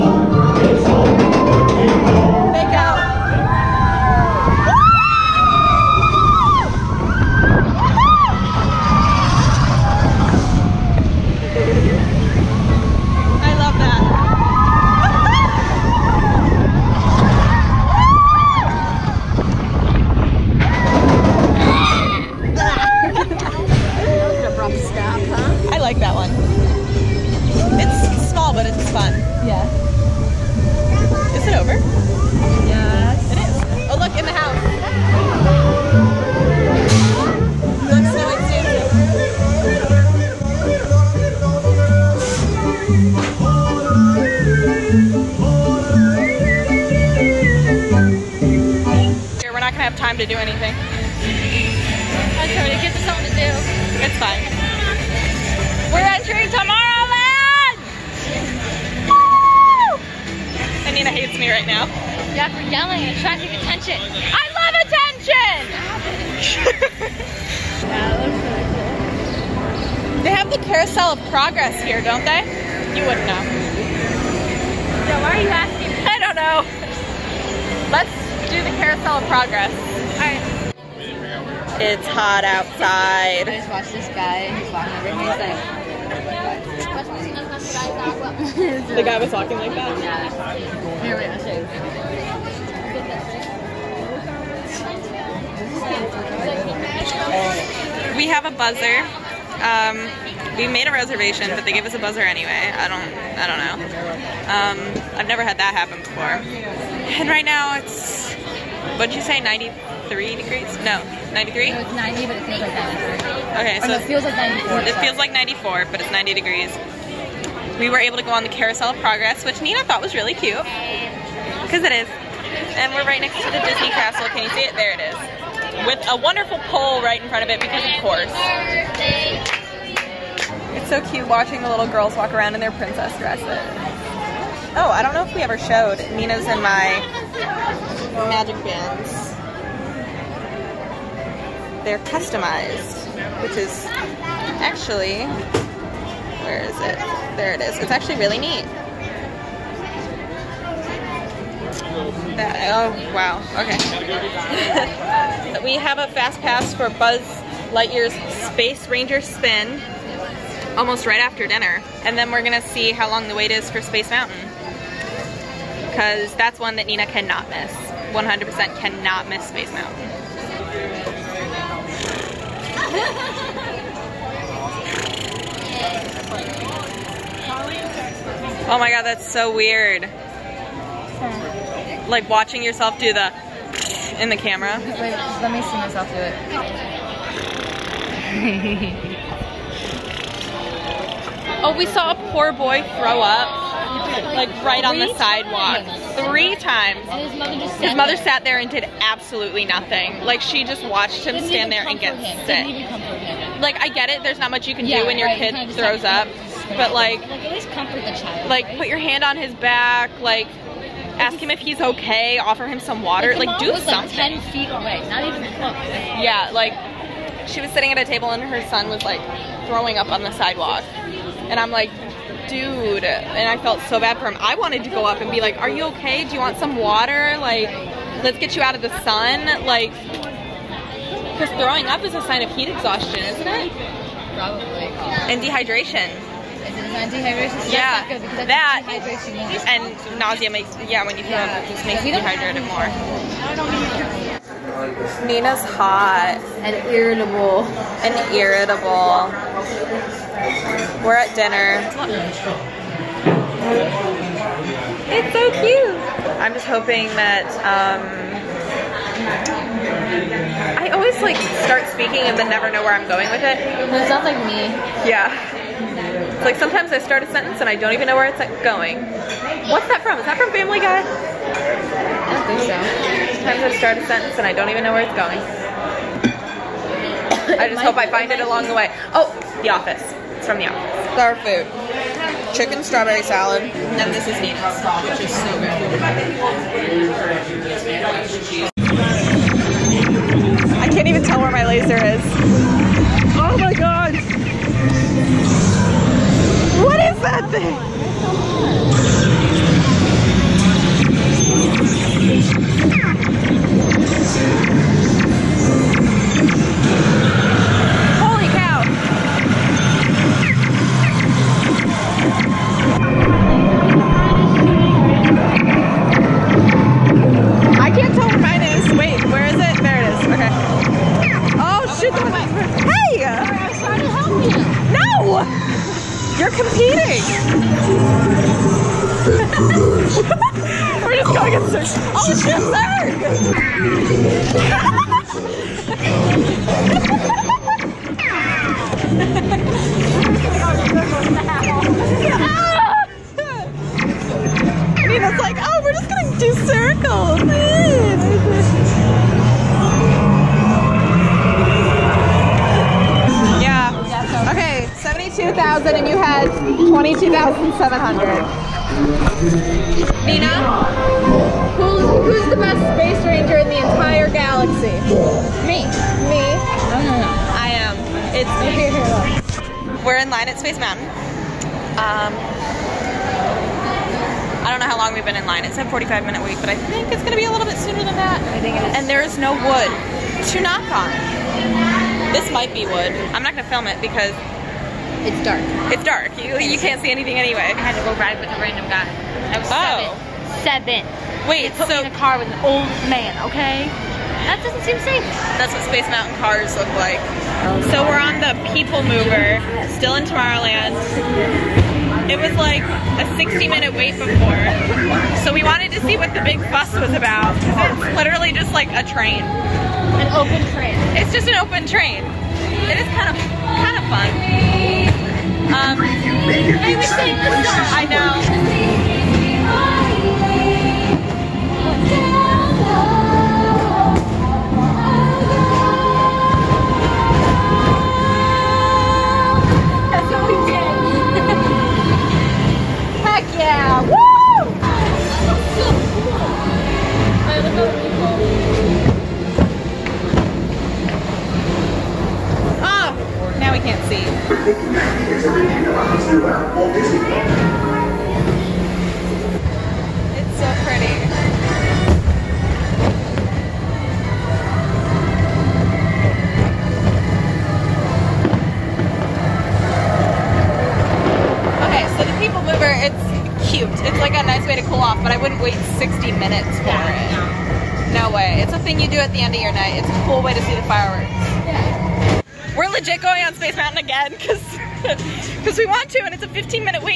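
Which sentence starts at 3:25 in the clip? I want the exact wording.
kid throws up but like, like comfort the child.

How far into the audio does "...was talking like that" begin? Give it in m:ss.
1:29.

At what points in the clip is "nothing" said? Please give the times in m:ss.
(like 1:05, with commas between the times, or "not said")
3:19.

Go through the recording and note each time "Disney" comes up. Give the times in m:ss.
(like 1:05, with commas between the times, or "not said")
2:03, 7:26.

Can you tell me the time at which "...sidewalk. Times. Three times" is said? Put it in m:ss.
3:15.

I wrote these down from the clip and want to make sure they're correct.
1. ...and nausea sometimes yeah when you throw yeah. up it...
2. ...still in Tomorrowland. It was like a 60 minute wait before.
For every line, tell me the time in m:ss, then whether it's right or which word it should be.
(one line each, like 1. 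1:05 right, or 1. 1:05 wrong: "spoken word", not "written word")
1. 3:59 wrong: "makes", not "sometimes"
2. 6:39 right.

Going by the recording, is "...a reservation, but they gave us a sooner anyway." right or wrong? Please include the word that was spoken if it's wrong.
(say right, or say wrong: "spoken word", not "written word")
wrong: "buzzer", not "sooner".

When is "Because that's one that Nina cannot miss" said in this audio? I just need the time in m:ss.
2:45.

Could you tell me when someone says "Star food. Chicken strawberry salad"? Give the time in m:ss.
4:41.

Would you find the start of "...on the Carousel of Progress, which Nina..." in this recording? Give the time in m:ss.
1:58.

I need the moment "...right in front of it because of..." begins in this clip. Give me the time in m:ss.
2:07.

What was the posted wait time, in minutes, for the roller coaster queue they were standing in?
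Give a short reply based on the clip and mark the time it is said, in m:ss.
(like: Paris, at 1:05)
45, at 6:15.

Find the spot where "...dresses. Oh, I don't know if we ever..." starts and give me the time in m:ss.
2:13.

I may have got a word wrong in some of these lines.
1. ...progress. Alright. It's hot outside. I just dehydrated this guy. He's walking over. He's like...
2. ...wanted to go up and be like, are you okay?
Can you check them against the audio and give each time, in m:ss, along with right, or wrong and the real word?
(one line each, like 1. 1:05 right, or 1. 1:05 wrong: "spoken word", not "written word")
1. 1:19 wrong: "watched", not "dehydrated"
2. 3:44 right.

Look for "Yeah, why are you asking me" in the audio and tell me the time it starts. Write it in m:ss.
1:15.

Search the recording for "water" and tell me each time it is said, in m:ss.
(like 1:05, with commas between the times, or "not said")
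3:33, 3:46.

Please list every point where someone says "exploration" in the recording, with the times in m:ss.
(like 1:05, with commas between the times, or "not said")
not said.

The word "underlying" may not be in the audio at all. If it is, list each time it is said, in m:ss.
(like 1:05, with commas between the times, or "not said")
not said.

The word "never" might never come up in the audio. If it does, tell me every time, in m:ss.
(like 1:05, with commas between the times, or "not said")
1:45, 4:22.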